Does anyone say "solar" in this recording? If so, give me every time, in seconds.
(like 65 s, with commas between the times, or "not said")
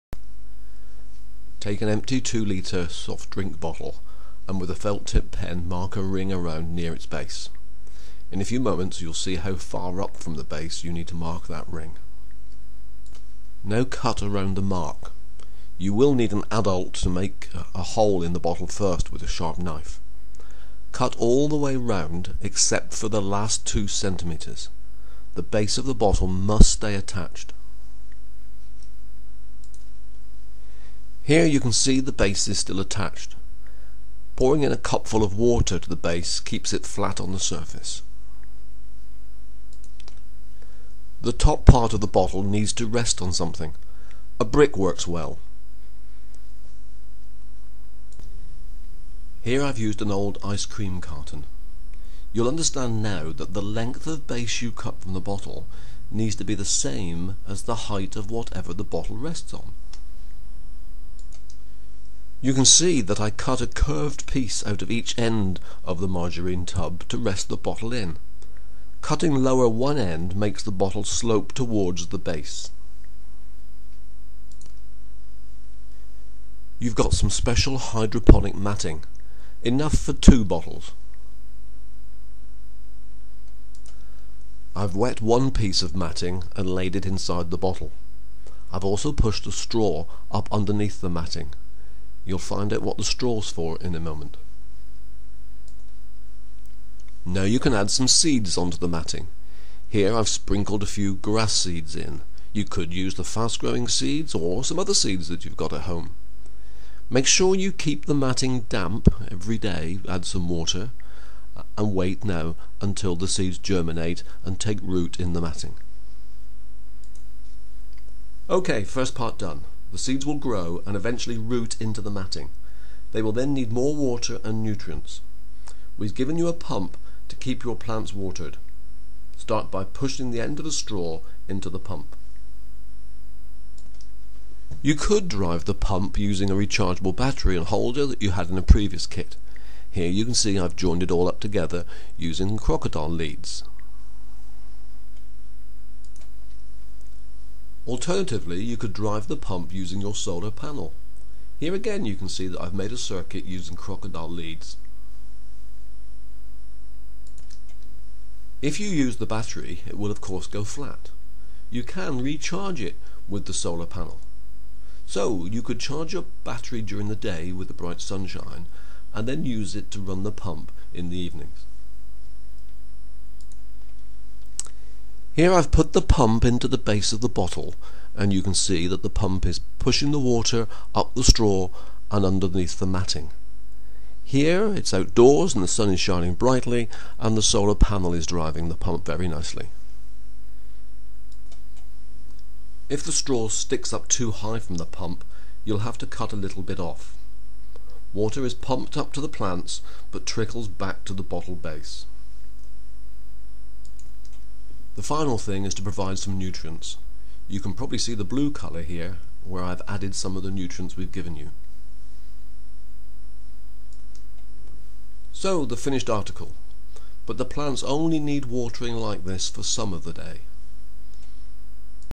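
150 s, 163 s, 187 s.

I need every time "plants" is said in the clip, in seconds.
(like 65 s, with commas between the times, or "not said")
127 s, 199 s, 217 s.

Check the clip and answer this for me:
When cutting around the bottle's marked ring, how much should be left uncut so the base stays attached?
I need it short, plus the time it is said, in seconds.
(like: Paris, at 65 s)
2 centimetres, at 23 s.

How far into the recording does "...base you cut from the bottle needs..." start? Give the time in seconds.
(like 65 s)
54 s.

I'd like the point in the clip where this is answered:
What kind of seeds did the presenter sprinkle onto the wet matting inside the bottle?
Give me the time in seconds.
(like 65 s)
101 s.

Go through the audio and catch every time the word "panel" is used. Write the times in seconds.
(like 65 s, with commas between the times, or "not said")
150 s, 163 s, 187 s.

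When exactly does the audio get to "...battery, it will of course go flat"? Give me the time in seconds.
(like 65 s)
159 s.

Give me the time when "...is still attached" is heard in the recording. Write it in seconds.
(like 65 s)
32 s.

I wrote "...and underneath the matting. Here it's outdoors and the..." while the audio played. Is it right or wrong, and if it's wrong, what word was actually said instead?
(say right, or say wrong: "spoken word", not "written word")
right.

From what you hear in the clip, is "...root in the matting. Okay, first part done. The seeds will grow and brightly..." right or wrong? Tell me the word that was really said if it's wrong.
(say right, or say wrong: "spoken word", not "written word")
wrong: "eventually", not "brightly".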